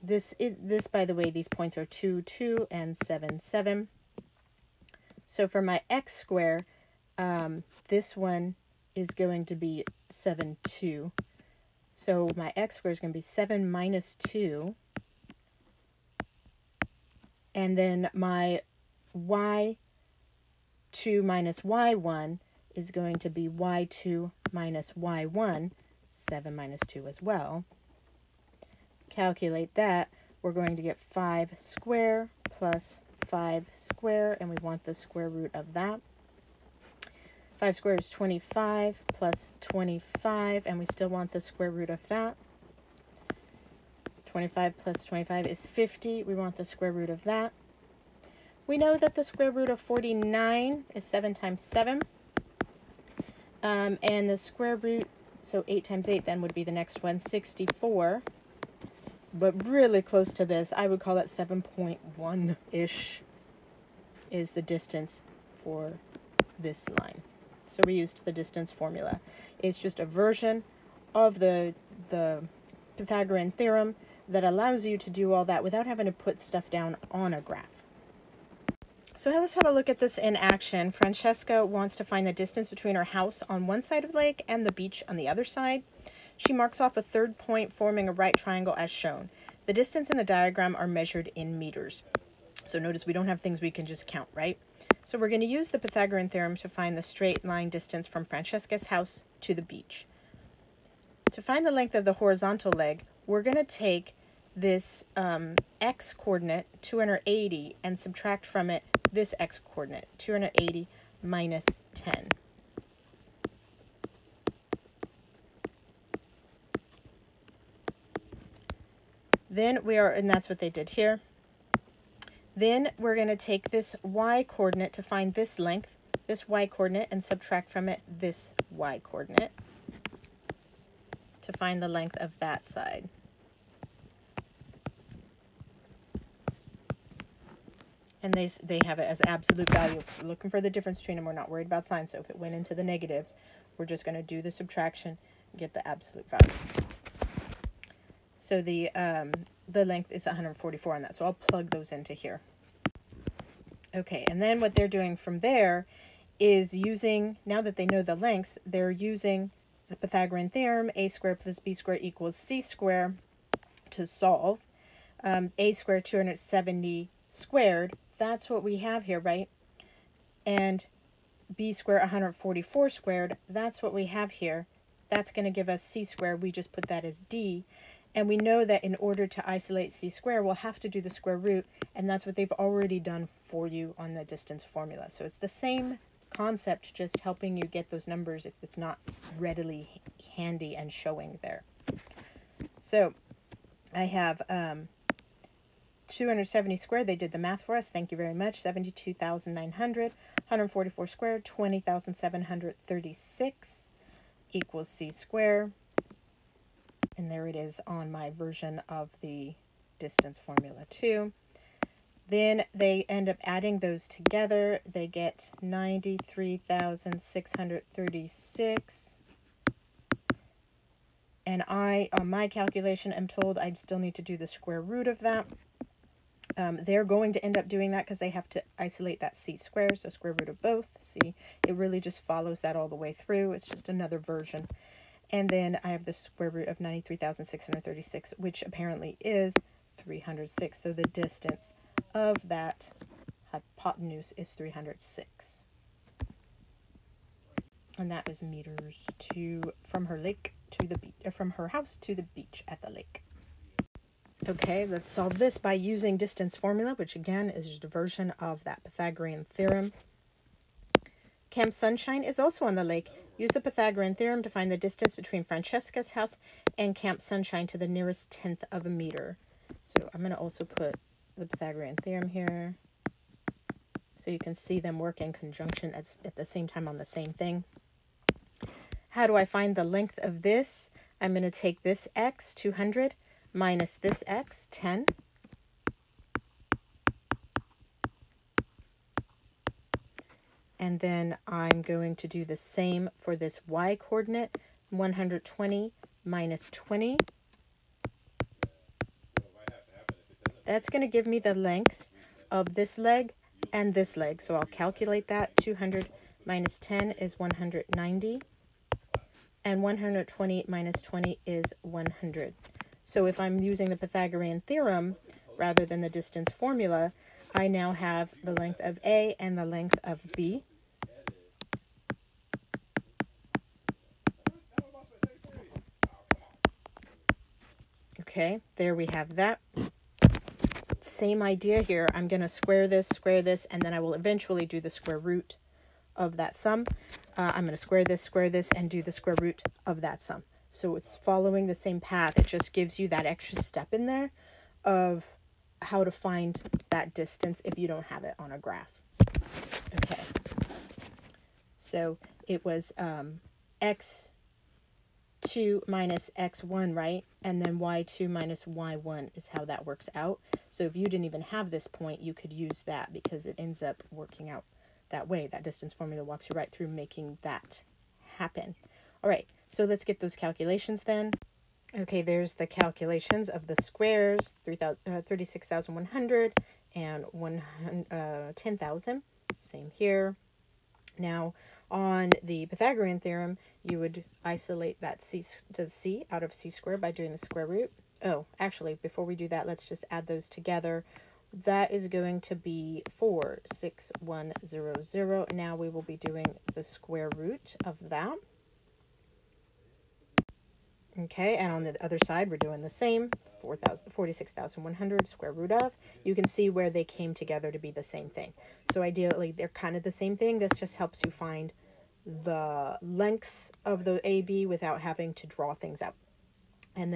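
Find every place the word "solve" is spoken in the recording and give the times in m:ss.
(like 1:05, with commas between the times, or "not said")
2:44, 4:15.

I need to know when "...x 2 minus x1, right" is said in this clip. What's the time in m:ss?
5:53.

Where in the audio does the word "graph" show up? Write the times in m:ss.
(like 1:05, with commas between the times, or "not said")
1:17, 5:48.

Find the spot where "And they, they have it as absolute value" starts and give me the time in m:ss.
2:18.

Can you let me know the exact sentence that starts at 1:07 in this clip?
So we used the distance formula.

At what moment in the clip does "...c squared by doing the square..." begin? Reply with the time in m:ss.
6:26.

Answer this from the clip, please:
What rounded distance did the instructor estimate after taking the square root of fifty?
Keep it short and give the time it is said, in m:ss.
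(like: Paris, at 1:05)
7.1, at 1:01.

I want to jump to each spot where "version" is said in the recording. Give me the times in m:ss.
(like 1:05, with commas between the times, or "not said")
1:10, 3:28, 3:54, 4:17.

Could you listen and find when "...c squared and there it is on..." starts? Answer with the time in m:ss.
3:24.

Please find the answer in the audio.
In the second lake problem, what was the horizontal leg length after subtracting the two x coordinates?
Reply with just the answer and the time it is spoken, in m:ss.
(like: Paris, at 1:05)
190, at 5:07.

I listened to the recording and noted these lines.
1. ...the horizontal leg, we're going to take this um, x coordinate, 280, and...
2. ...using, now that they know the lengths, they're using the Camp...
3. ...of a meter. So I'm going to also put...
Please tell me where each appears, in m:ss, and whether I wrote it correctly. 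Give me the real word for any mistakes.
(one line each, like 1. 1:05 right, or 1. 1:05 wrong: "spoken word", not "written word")
1. 1:42 right
2. 2:36 wrong: "Pythagorean", not "Camp"
3. 4:28 right.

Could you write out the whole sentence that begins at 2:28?
So the um, the length is 144 on that.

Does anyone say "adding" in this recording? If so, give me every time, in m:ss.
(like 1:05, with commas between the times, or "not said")
3:33.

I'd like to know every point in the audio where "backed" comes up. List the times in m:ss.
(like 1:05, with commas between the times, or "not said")
not said.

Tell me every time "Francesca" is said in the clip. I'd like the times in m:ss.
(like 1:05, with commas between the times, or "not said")
1:20, 1:38, 4:25.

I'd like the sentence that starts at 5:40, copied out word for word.
So it's following the same path.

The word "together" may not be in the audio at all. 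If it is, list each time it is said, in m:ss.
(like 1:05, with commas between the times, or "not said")
3:34, 6:30, 6:47.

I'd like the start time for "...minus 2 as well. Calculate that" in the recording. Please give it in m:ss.
0:26.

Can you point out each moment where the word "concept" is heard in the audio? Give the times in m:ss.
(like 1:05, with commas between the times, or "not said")
3:06.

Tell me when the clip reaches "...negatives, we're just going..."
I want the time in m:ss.
2:22.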